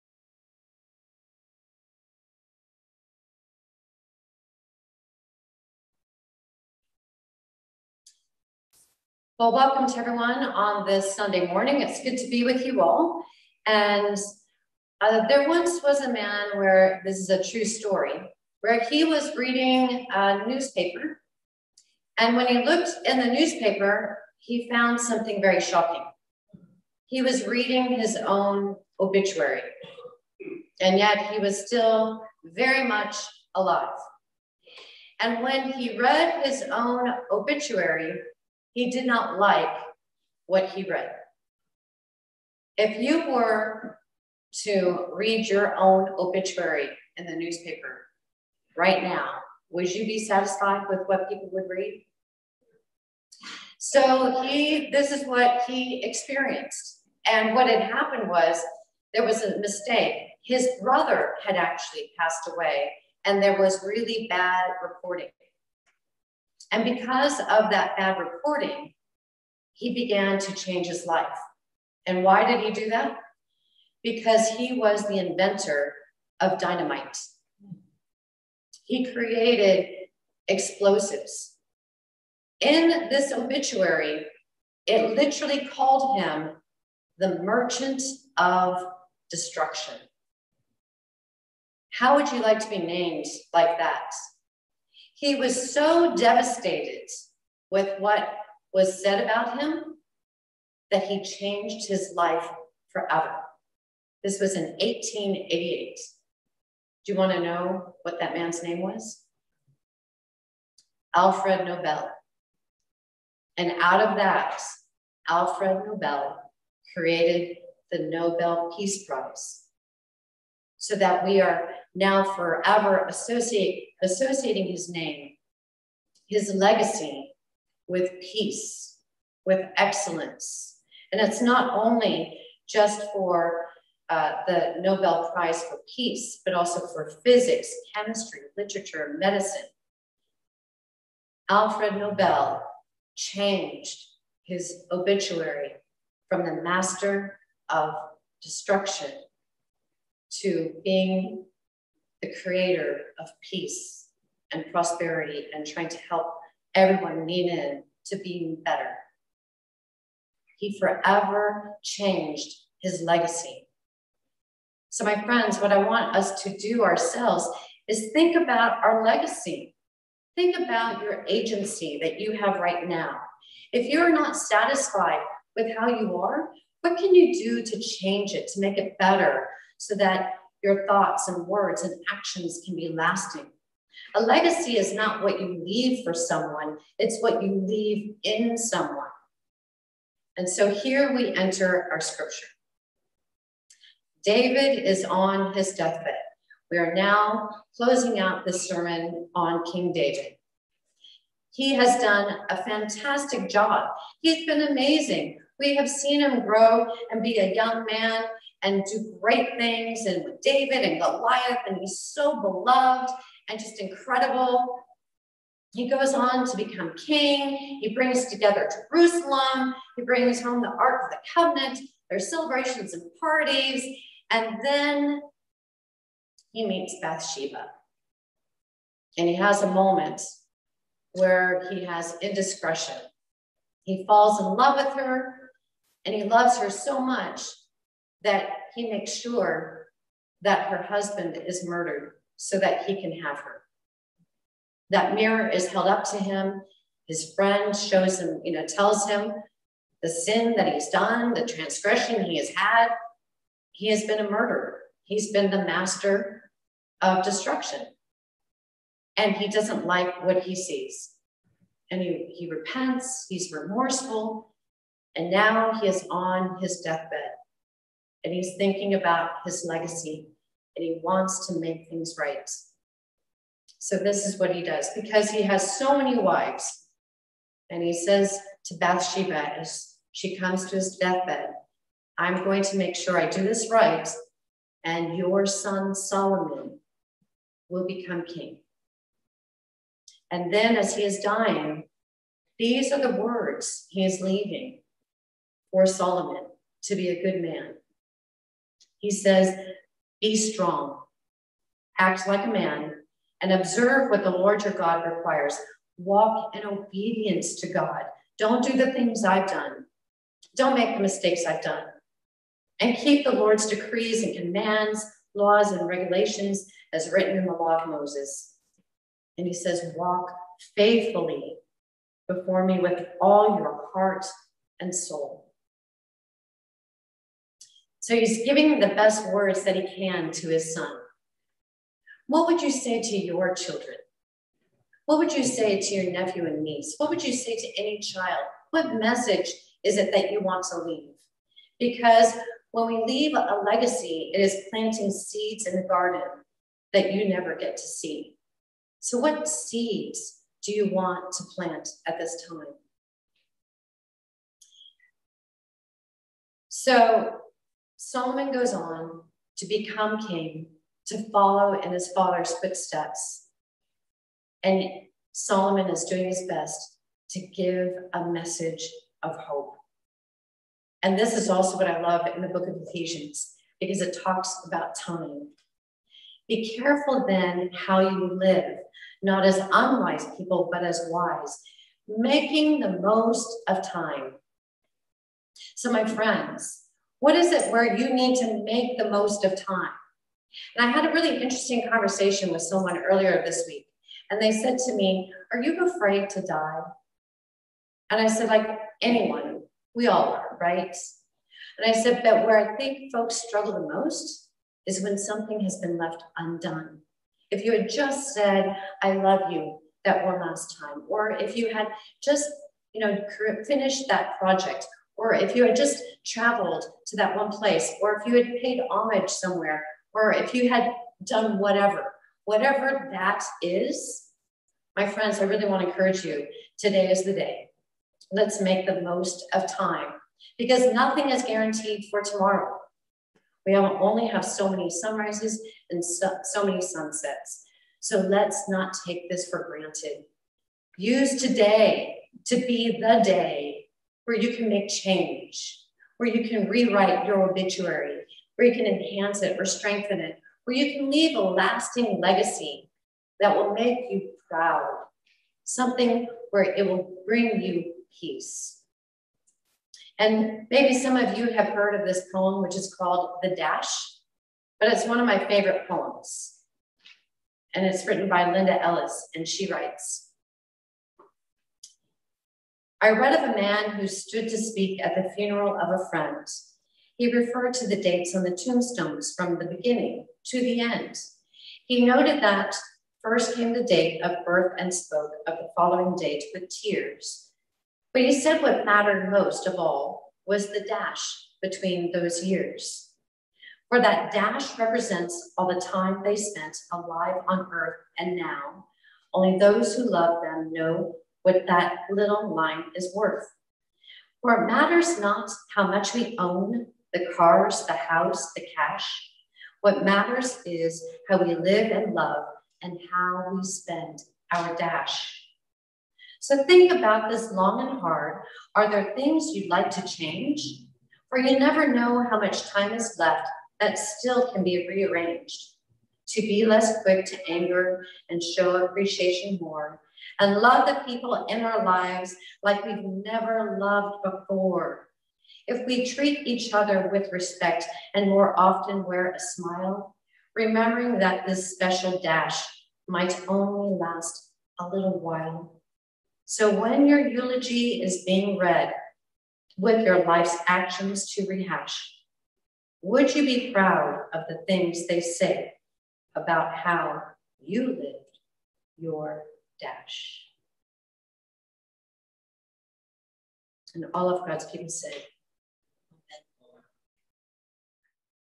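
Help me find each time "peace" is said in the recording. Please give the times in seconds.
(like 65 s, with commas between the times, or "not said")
118 s, 128 s, 135 s, 153 s, 458 s.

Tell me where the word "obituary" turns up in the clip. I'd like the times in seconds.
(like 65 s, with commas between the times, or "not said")
28 s, 37 s, 46 s, 83 s, 144 s, 447 s.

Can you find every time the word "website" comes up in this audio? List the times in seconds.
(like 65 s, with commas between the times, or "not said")
not said.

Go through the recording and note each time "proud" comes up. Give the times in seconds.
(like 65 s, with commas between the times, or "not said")
454 s, 553 s.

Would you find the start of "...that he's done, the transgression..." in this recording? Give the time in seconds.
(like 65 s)
250 s.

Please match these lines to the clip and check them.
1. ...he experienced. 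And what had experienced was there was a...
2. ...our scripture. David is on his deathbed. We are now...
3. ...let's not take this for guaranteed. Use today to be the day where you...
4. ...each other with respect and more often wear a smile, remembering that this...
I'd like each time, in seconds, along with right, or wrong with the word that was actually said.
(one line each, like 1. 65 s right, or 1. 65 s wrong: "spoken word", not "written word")
1. 55 s wrong: "happened", not "experienced"
2. 191 s right
3. 438 s wrong: "granted", not "guaranteed"
4. 536 s right.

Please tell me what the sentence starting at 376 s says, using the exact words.
Be careful then how you live, not as unwise people, but as wise, making the most of time.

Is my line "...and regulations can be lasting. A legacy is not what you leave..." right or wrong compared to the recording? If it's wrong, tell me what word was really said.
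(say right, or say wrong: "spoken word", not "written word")
wrong: "actions", not "regulations".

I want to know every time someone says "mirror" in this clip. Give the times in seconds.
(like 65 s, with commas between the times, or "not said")
245 s.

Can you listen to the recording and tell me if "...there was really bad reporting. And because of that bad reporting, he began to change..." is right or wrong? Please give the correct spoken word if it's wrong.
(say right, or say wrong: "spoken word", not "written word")
right.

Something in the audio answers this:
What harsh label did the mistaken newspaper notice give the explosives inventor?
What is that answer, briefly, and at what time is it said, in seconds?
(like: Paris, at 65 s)
merchant of destruction, at 87 s.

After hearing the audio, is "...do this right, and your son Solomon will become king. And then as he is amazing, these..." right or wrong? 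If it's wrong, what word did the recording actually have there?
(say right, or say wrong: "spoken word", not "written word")
wrong: "dying", not "amazing".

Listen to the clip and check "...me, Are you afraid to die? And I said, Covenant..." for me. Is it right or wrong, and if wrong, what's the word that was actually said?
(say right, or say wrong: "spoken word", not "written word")
wrong: "Like", not "Covenant".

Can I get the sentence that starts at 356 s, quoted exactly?
So, Solomon goes on to become king, to follow in his father's footsteps.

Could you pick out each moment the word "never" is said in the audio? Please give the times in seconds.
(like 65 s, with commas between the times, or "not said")
347 s, 521 s, 533 s.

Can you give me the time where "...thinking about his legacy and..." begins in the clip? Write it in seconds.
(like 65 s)
268 s.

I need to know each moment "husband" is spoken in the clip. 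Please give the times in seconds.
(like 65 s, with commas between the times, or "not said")
240 s.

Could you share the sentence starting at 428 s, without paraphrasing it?
Let's make the most of time because nothing is guaranteed for tomorrow.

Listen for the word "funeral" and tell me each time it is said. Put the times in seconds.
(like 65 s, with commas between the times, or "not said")
475 s.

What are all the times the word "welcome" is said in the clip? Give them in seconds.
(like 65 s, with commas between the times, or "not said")
9 s.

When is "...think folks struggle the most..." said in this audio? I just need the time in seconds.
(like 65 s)
402 s.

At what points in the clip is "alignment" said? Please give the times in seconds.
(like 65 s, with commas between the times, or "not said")
not said.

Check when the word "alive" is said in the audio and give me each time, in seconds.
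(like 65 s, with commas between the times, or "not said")
33 s, 496 s.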